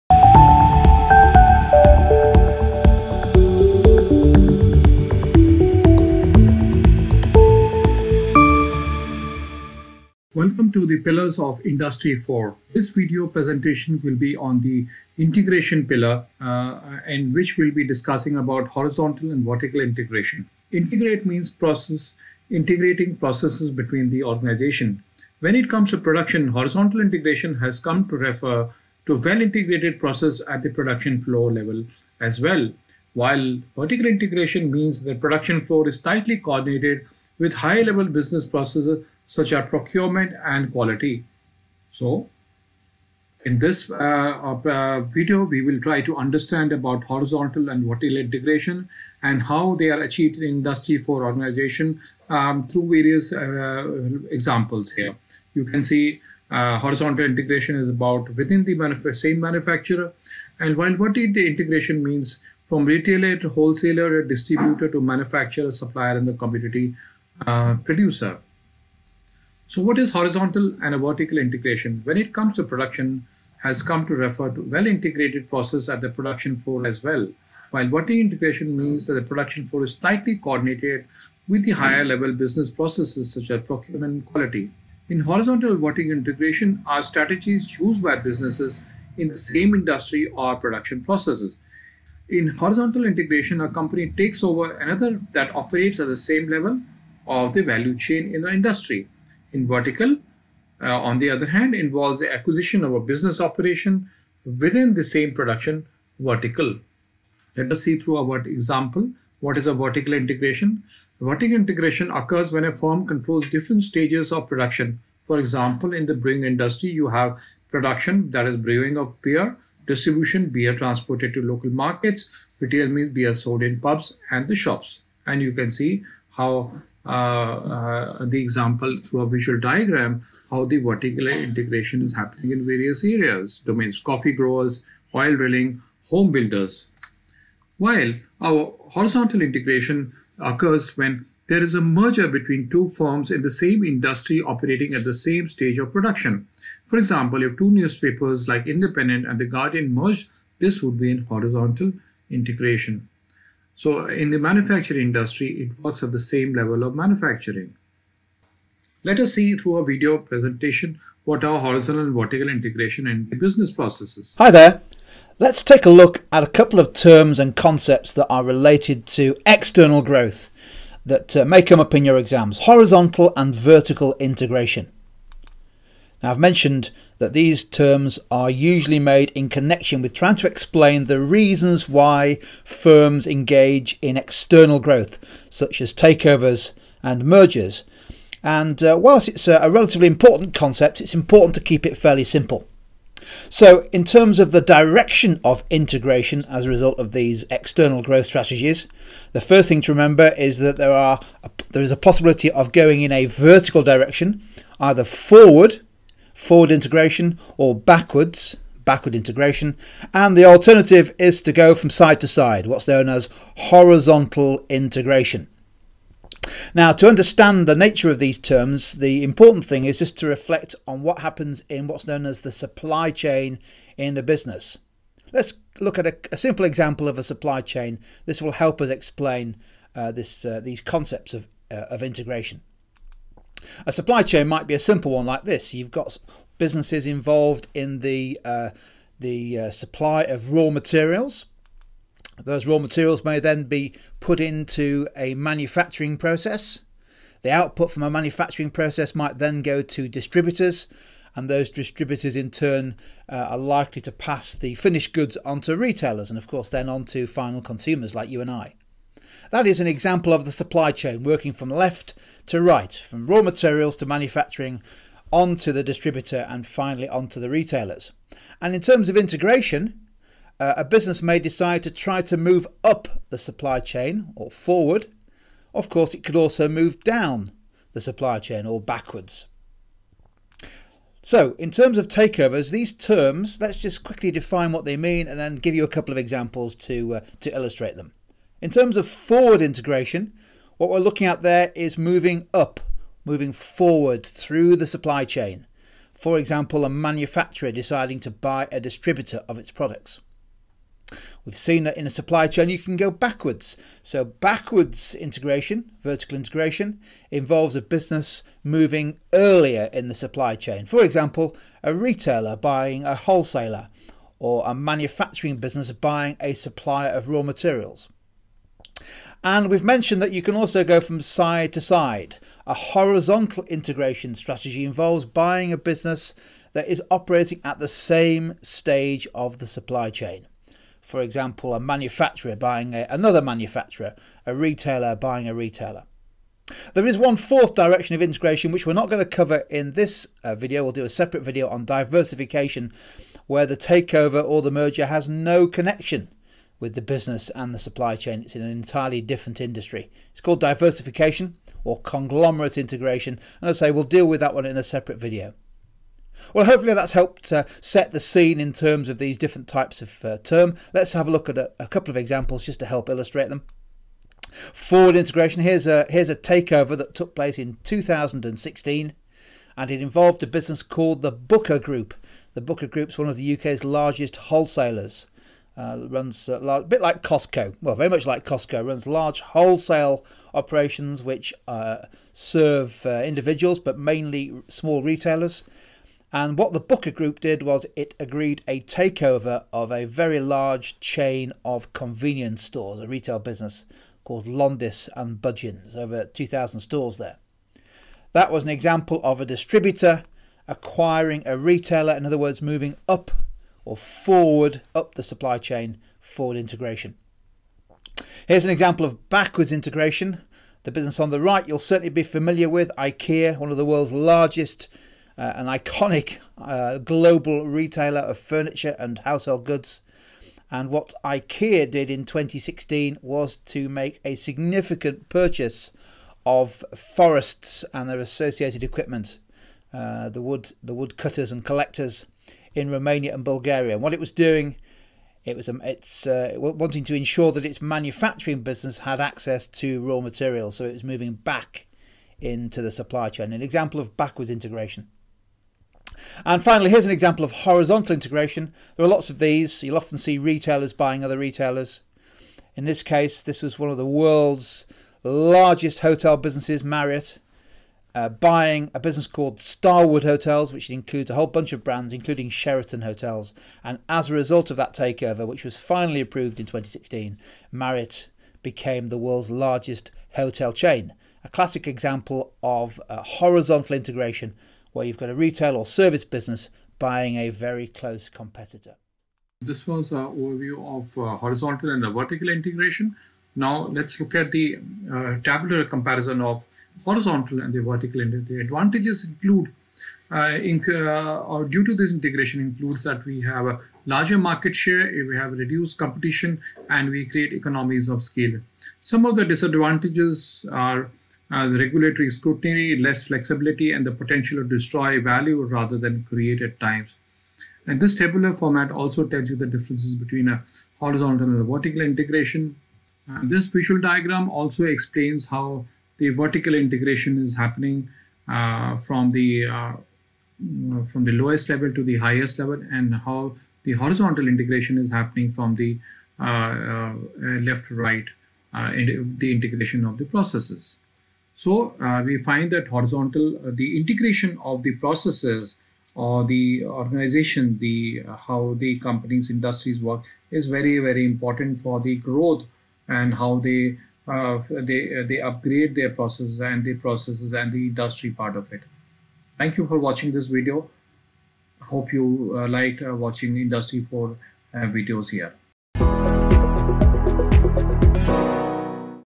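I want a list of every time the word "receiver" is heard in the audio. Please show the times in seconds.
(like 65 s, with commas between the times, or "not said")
not said.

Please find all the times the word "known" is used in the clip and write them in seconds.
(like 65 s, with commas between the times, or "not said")
212 s, 222 s.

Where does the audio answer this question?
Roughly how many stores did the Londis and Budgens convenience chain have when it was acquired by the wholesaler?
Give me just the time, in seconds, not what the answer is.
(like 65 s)
395 s.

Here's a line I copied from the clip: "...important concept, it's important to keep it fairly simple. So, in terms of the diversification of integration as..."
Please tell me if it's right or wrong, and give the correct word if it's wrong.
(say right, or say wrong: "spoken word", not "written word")
wrong: "direction", not "diversification".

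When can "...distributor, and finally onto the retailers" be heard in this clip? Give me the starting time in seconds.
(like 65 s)
265 s.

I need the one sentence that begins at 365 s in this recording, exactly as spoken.
Here's a here's a takeover that took place in 2016, and it involved a business called the Booker Group.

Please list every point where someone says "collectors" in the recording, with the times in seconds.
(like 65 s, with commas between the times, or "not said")
431 s.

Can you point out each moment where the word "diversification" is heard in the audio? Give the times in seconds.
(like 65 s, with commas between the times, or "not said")
341 s, 350 s.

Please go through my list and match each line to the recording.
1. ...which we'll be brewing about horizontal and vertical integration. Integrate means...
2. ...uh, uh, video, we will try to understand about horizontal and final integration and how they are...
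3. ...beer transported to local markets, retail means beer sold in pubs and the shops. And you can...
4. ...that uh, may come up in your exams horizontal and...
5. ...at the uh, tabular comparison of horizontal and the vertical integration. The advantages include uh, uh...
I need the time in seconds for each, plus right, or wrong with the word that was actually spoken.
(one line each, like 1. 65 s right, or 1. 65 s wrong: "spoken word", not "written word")
1. 17 s wrong: "discussing", not "brewing"
2. 43 s wrong: "vertical", not "final"
3. 120 s right
4. 171 s right
5. 484 s right.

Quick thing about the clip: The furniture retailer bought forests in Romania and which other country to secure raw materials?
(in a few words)
Bulgaria.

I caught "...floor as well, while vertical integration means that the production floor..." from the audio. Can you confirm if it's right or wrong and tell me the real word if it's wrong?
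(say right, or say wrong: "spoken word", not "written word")
right.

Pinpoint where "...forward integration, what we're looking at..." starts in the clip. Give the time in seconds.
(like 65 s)
289 s.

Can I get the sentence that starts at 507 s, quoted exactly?
And this tabular format also tells you the differences between a horizontal and a vertical integration.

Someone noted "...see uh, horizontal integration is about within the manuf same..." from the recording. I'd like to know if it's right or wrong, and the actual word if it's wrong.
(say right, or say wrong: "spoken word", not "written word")
right.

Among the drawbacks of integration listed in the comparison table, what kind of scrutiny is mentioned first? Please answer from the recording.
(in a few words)
Regulatory scrutiny.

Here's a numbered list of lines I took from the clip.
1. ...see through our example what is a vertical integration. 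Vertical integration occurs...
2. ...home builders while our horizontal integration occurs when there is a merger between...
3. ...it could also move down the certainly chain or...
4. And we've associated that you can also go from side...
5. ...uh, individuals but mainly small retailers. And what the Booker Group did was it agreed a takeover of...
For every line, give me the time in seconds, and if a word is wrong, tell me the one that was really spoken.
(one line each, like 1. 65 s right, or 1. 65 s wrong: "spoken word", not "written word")
1. 107 s right
2. 136 s right
3. 276 s wrong: "supply", not "certainly"
4. 319 s wrong: "mentioned", not "associated"
5. 383 s right.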